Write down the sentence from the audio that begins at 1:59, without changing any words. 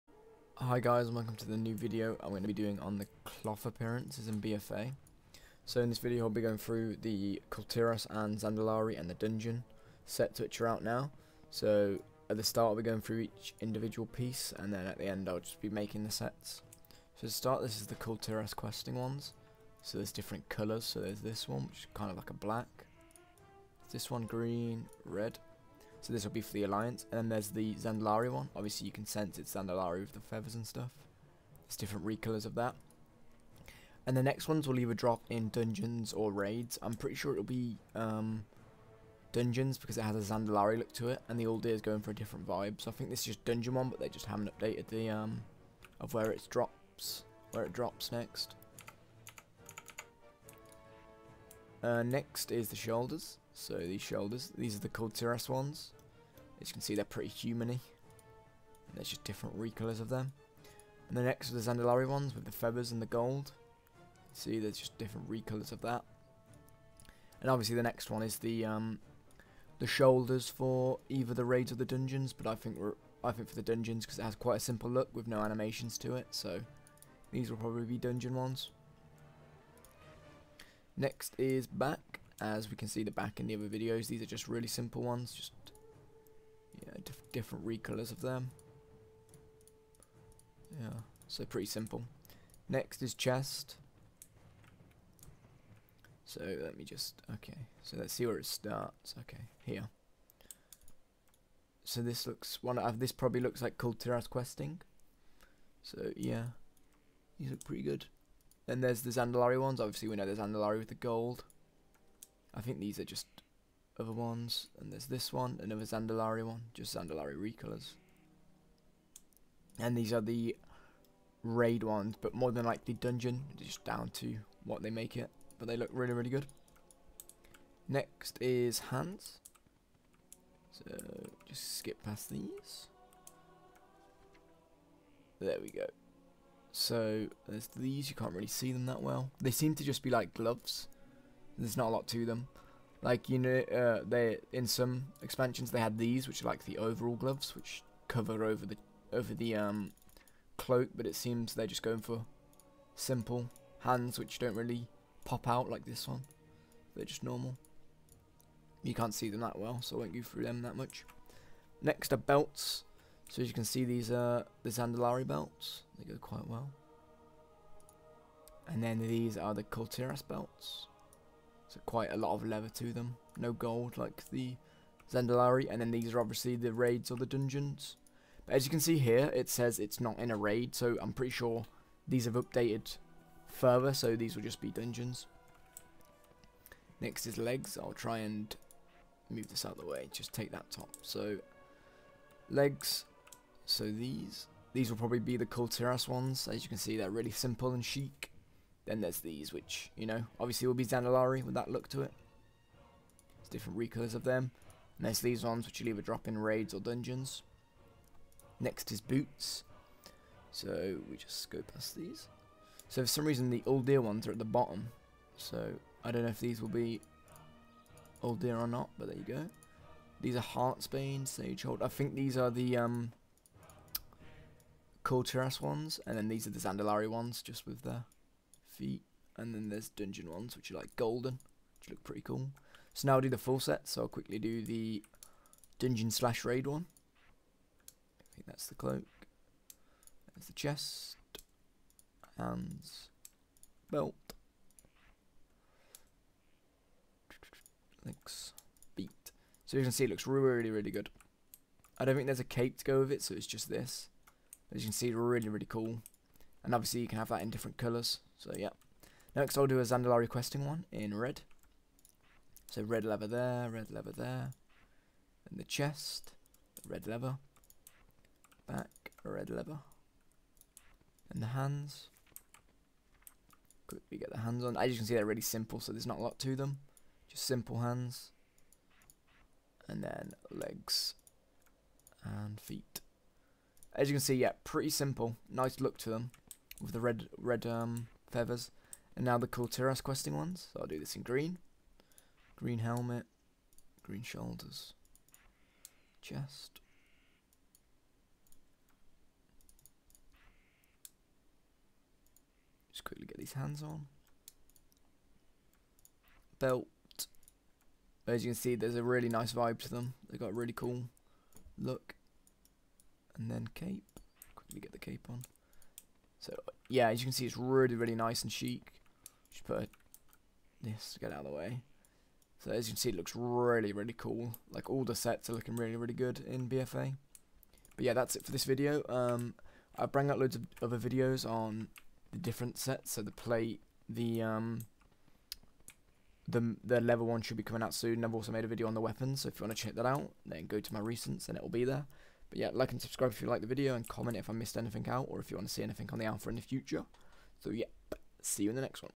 And these are the raid ones, but more than likely dungeon, just down to what they make it.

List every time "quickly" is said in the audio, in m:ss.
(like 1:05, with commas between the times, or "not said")
3:54, 4:33, 5:03, 5:14.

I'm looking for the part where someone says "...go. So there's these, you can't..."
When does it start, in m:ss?
2:15.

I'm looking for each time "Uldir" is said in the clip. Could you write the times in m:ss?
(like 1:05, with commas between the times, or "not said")
0:41.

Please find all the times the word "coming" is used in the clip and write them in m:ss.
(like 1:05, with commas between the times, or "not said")
5:37.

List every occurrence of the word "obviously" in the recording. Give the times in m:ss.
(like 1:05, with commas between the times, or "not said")
0:28, 1:07, 1:49, 2:56, 3:20, 4:16.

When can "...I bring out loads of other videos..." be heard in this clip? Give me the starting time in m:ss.
5:29.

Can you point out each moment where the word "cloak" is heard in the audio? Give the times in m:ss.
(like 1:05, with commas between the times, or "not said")
2:30, 3:58.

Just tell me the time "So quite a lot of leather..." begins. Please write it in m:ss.
2:51.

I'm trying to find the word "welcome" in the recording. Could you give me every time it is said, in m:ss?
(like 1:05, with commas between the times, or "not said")
0:01.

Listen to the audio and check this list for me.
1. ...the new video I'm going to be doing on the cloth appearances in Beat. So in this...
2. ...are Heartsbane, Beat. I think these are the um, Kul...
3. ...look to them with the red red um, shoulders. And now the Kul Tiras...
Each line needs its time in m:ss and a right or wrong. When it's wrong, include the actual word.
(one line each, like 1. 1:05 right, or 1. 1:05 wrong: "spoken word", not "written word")
1. 0:01 wrong: "BFA", not "Beat"
2. 3:40 wrong: "Sagehold", not "Beat"
3. 4:45 wrong: "feathers", not "shoulders".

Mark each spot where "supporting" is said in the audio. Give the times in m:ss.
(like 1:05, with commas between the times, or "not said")
not said.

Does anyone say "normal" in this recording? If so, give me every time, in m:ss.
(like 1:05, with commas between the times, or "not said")
2:37.